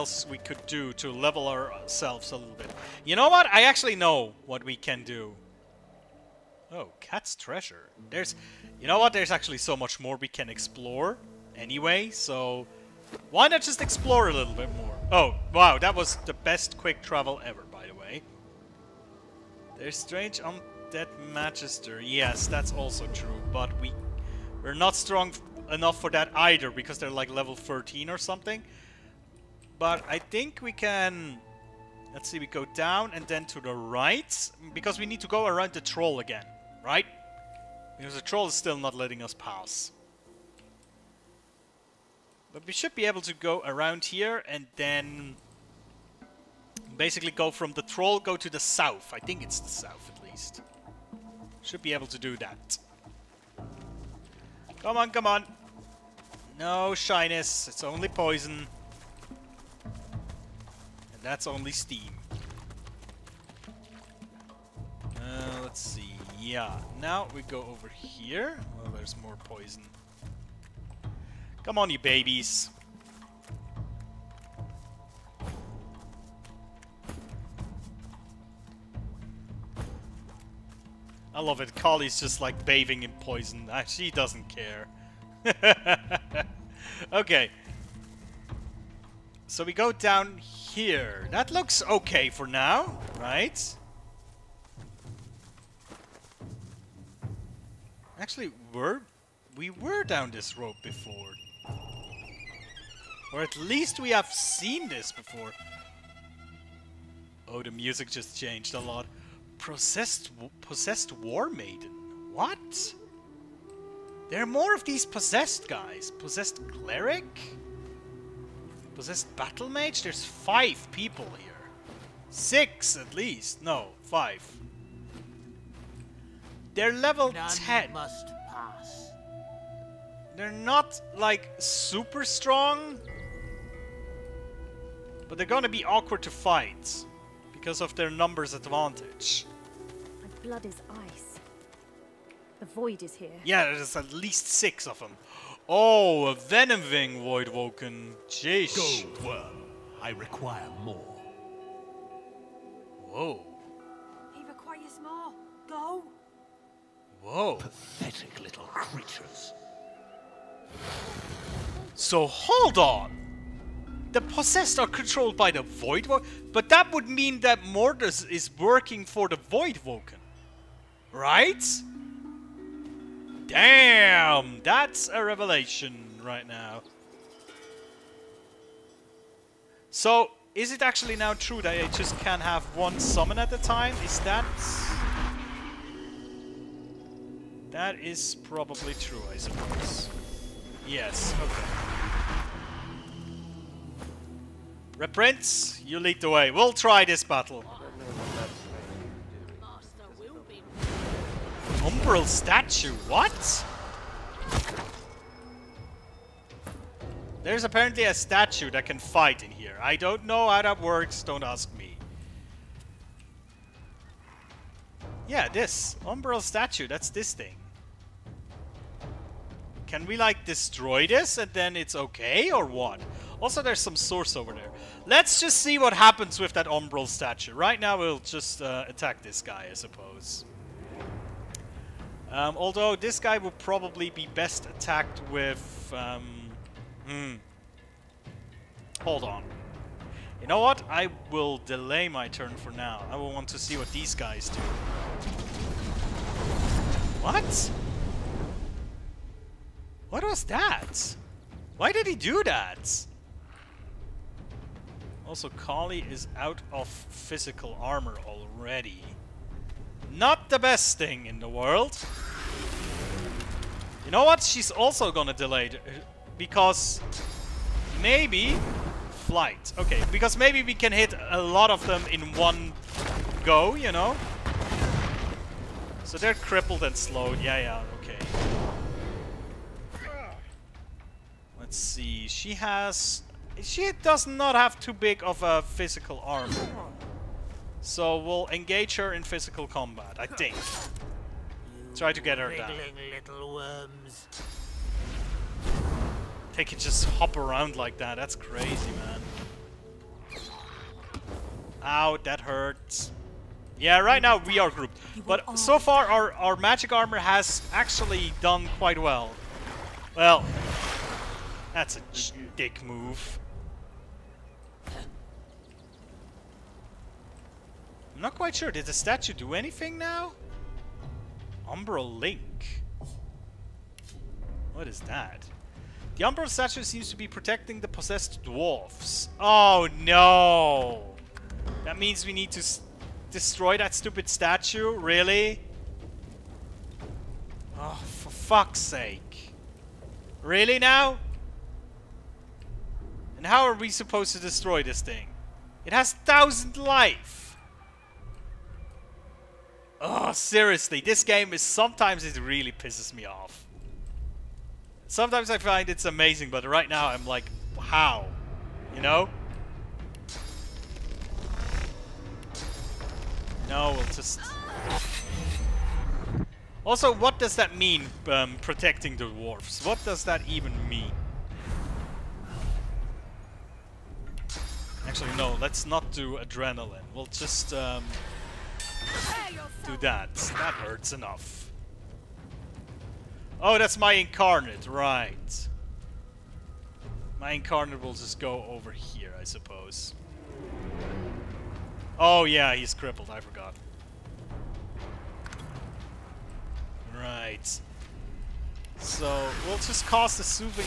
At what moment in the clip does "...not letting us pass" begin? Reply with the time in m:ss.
0:38.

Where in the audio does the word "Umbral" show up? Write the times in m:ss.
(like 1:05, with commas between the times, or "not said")
3:21, 3:36, 3:46, 5:21, 5:26.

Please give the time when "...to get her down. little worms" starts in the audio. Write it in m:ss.
4:52.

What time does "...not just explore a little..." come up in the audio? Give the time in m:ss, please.
0:13.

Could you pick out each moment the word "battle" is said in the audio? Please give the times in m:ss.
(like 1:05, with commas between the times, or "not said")
1:59, 3:17.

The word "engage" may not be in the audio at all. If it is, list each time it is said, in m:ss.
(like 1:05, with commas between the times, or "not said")
4:48.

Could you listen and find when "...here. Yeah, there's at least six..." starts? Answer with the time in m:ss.
2:23.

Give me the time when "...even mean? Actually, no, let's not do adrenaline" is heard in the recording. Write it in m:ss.
6:10.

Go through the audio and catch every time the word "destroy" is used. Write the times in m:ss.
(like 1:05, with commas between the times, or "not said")
3:40, 5:33, 5:44.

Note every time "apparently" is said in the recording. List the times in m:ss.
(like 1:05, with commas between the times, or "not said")
3:27.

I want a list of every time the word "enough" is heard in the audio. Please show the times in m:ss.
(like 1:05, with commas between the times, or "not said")
0:25, 6:21.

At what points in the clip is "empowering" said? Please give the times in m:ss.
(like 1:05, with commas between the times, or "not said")
not said.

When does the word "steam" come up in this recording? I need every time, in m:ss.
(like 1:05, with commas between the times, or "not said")
1:01.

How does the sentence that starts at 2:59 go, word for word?
So, is it actually now true that I just can have one summon at a time?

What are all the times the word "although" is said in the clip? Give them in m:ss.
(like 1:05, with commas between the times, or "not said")
3:52.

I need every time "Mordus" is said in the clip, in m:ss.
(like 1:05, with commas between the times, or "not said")
2:47.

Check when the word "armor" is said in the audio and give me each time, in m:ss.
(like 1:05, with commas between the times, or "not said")
4:17, 4:46, 5:06.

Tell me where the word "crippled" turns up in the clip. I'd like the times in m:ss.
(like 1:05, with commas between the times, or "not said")
4:36, 6:32.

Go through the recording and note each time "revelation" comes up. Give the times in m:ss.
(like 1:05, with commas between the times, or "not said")
2:55.